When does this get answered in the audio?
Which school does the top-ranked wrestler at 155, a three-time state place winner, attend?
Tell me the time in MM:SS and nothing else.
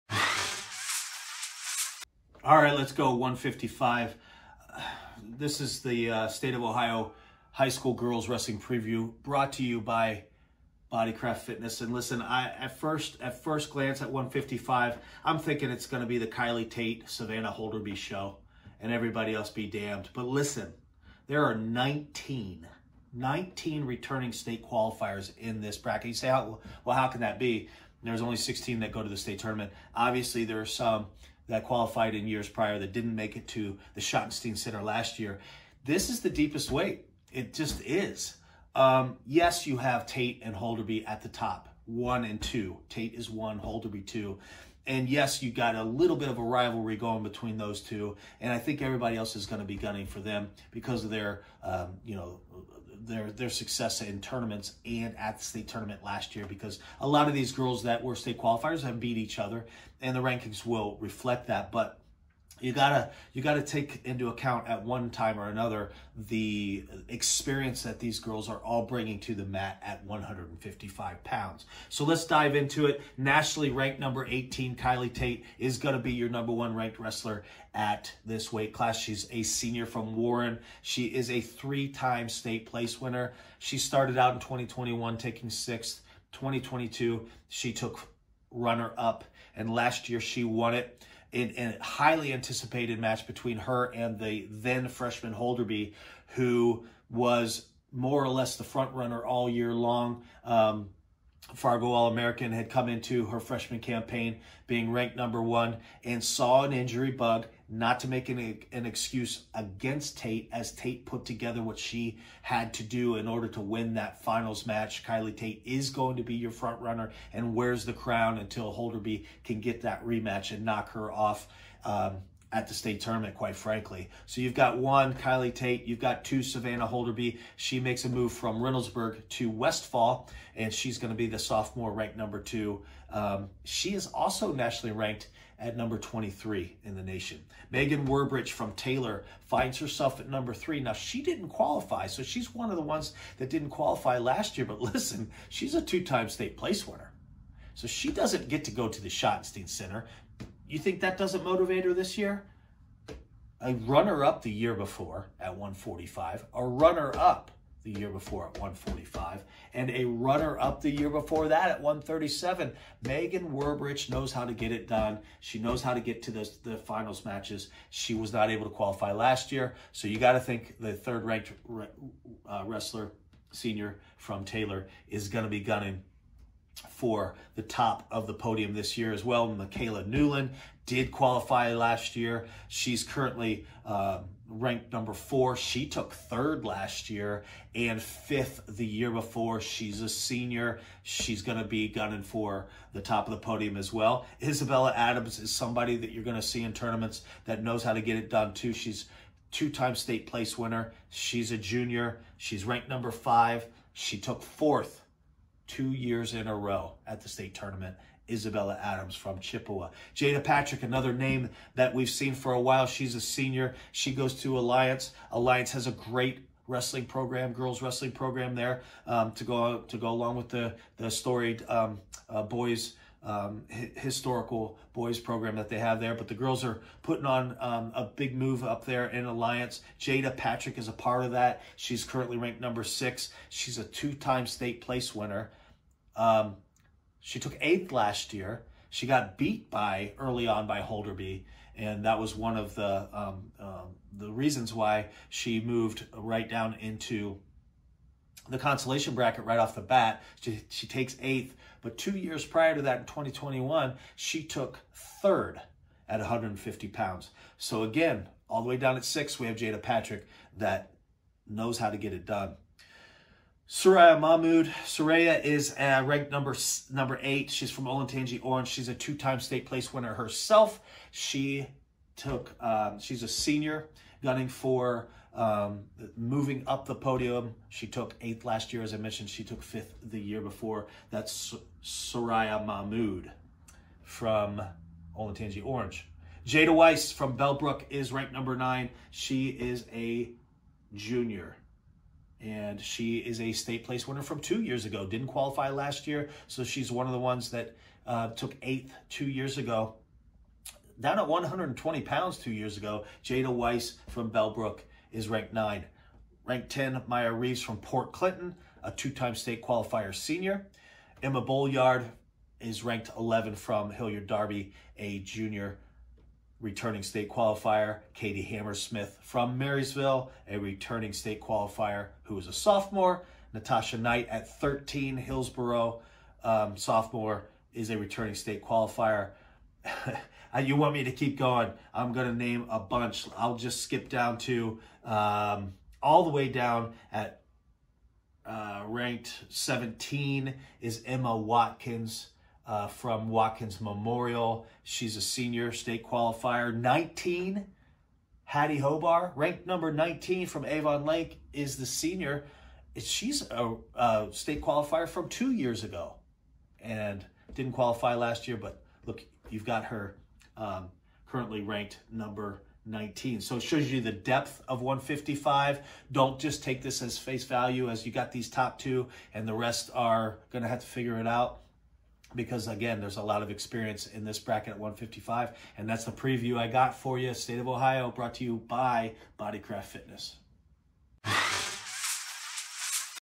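01:20.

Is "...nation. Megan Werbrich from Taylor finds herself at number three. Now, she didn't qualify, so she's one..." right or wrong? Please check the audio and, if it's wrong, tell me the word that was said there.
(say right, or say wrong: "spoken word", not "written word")
right.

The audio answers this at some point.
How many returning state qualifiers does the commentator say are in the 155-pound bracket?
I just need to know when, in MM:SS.
00:21.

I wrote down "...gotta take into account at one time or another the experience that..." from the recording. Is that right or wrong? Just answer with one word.
right.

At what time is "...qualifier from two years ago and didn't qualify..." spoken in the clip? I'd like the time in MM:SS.
05:54.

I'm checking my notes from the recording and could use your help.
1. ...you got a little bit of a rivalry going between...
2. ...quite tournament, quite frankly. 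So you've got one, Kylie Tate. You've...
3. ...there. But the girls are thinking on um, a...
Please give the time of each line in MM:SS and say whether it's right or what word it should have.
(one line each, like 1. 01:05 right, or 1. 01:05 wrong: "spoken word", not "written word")
1. 00:45 right
2. 02:02 wrong: "state", not "quite"
3. 03:45 wrong: "putting", not "thinking".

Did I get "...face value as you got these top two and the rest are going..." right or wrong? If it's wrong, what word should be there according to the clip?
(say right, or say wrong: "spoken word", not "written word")
right.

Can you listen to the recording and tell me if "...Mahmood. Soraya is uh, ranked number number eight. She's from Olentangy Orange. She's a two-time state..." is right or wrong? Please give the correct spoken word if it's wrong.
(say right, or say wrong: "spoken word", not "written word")
right.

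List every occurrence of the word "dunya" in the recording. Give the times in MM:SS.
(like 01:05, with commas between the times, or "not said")
not said.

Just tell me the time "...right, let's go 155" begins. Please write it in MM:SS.
00:02.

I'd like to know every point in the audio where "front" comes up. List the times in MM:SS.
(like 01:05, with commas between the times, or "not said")
01:38, 01:56.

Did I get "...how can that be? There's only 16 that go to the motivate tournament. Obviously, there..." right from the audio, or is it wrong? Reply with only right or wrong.
wrong.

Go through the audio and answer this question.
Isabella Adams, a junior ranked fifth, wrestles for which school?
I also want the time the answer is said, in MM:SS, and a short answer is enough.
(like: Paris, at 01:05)
Chippewa, at 03:29.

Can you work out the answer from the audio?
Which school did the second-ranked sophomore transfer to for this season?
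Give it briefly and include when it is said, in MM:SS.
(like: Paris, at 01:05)
Westfall, at 02:09.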